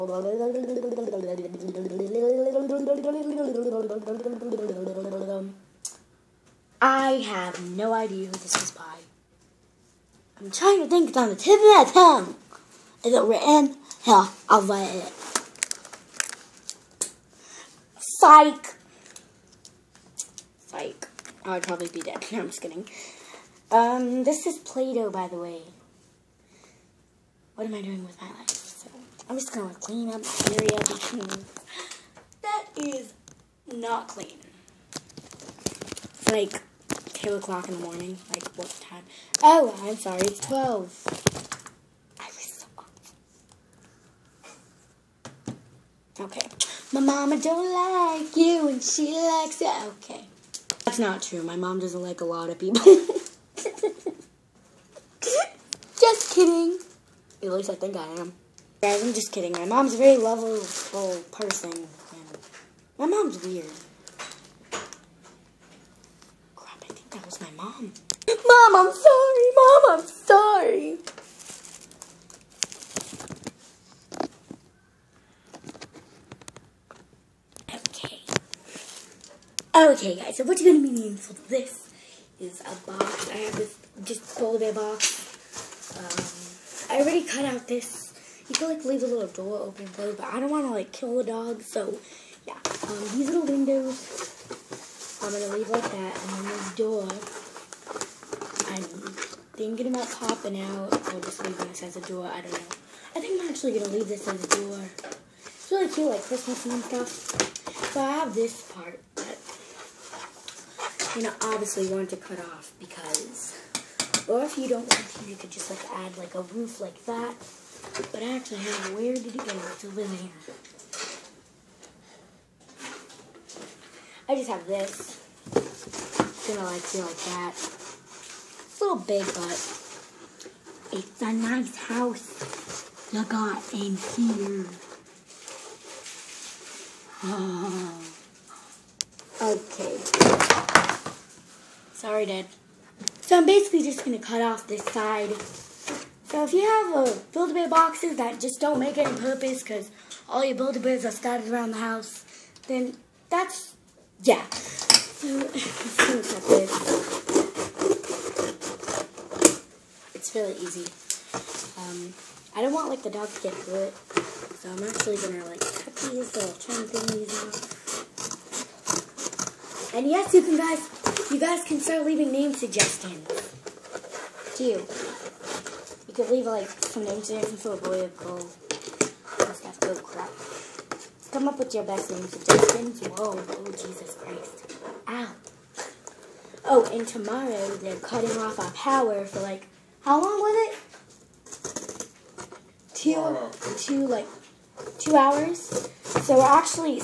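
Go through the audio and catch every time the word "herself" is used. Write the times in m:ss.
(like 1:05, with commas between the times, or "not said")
not said.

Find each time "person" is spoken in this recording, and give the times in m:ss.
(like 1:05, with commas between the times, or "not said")
1:01.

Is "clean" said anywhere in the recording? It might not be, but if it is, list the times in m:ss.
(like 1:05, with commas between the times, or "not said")
0:29, 0:34.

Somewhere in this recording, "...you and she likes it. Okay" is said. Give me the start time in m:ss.
0:48.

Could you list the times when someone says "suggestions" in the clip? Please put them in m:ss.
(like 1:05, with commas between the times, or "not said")
2:52, 2:57, 3:02.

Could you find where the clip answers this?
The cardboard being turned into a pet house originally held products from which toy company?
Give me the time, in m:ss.
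2:27.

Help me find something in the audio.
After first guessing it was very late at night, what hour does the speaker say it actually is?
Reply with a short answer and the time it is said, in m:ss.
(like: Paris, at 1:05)
12, at 0:40.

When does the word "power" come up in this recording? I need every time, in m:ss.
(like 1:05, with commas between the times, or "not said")
3:08.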